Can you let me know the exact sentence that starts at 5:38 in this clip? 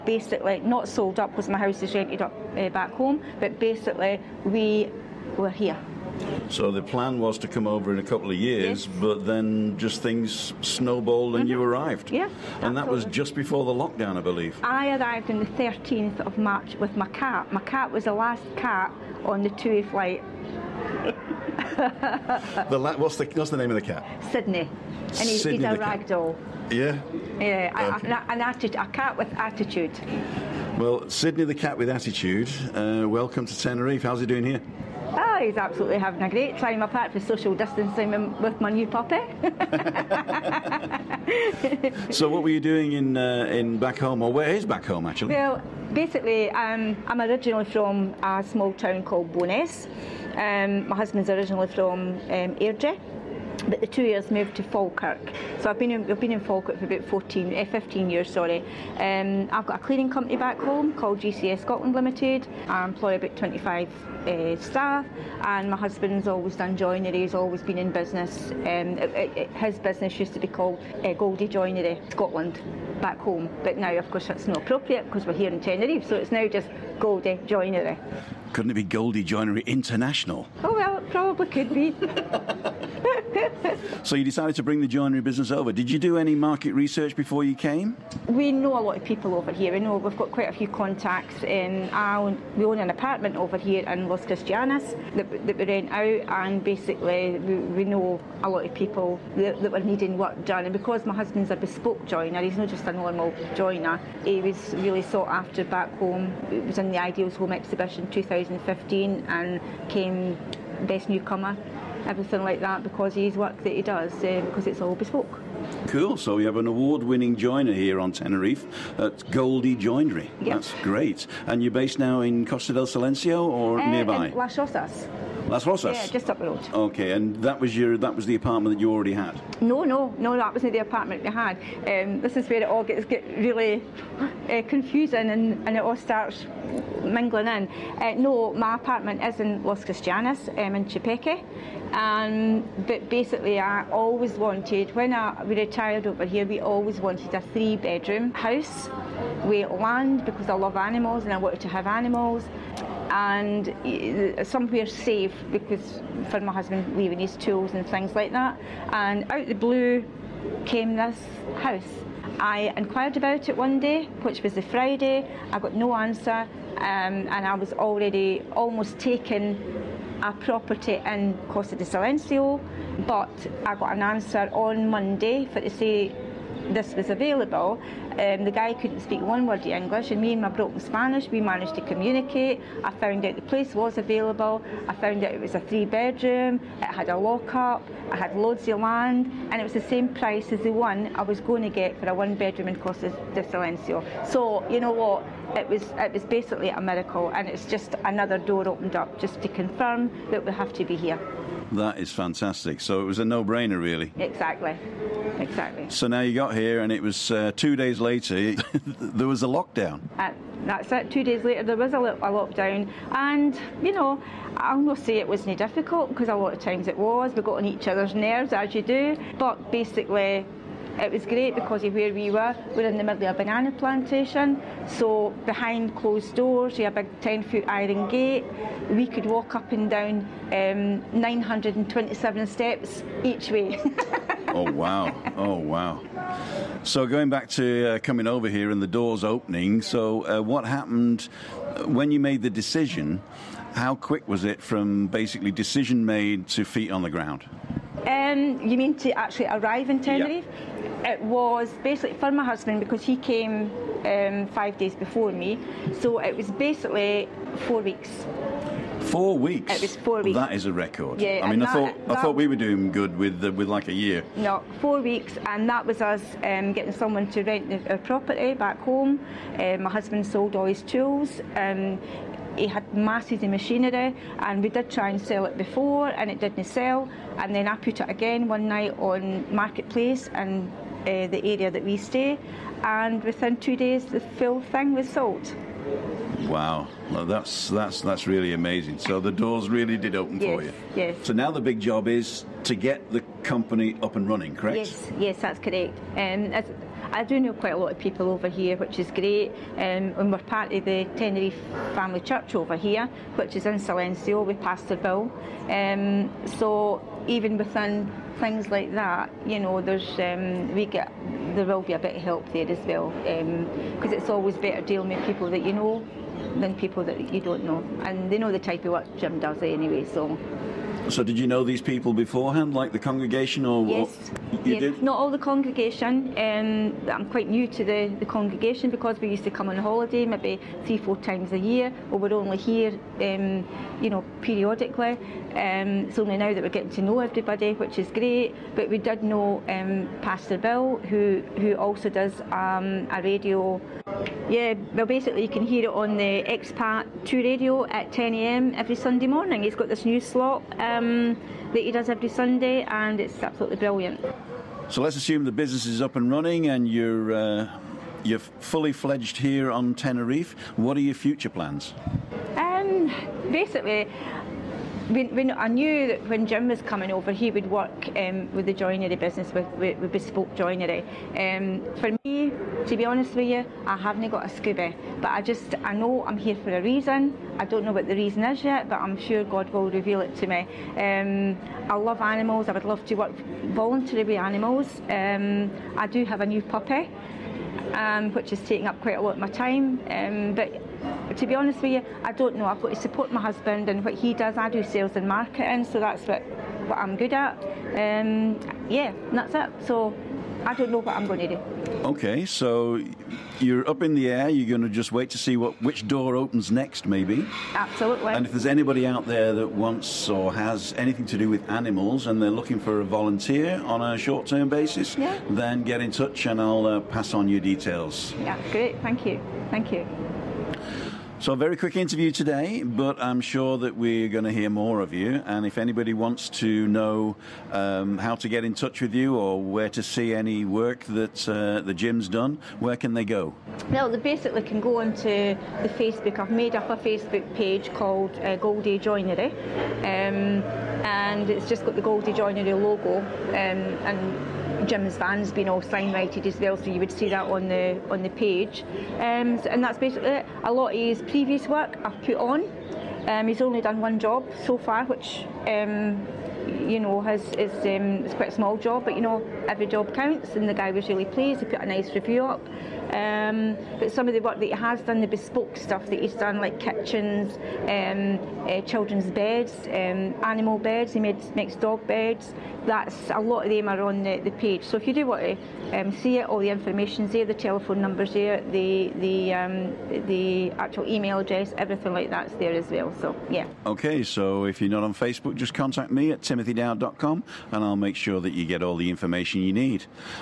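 But we did know um, Pastor Bill, who who also does um, a radio.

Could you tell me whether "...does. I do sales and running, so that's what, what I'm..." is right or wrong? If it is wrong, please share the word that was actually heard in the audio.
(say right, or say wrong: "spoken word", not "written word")
wrong: "marketing", not "running".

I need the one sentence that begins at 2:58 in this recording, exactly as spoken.
Um, the guy couldn't speak one word of English, and me and my broken Spanish, we managed to communicate.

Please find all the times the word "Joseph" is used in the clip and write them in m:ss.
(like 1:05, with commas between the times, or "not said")
not said.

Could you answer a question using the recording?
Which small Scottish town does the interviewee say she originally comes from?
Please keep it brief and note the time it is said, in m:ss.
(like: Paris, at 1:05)
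Bo'ness, at 0:49.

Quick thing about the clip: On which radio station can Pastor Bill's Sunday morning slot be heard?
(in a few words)
Expat Two Radio.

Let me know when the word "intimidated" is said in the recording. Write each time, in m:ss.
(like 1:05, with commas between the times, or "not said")
not said.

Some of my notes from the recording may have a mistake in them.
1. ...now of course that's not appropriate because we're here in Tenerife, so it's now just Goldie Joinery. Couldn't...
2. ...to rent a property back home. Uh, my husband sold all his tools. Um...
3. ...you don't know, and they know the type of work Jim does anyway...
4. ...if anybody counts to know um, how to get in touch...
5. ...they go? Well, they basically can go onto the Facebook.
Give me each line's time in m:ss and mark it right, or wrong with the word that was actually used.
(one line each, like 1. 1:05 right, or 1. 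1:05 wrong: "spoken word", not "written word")
1. 1:13 right
2. 4:27 right
3. 5:17 right
4. 7:05 wrong: "wants", not "counts"
5. 7:13 right.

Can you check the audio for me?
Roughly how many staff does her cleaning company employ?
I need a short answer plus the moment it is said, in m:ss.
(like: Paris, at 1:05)
25, at 1:03.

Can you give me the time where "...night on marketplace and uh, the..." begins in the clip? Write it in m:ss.
4:38.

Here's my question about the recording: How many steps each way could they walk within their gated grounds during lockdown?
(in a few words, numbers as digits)
927.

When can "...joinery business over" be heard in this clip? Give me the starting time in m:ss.
1:24.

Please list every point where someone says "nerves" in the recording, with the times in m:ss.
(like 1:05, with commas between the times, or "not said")
3:38.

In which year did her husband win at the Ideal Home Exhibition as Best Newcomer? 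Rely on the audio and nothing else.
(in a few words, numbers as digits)
2015.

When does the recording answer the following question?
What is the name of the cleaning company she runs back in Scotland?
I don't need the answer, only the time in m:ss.
1:01.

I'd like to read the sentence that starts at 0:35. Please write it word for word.
Oh, he's absolutely having a great time, apart from social distancing with my new puppy.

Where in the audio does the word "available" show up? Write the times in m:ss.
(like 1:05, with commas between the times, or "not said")
2:57, 3:03.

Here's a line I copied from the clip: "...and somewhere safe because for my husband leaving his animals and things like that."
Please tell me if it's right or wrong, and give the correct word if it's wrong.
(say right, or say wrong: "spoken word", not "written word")
wrong: "tools", not "animals".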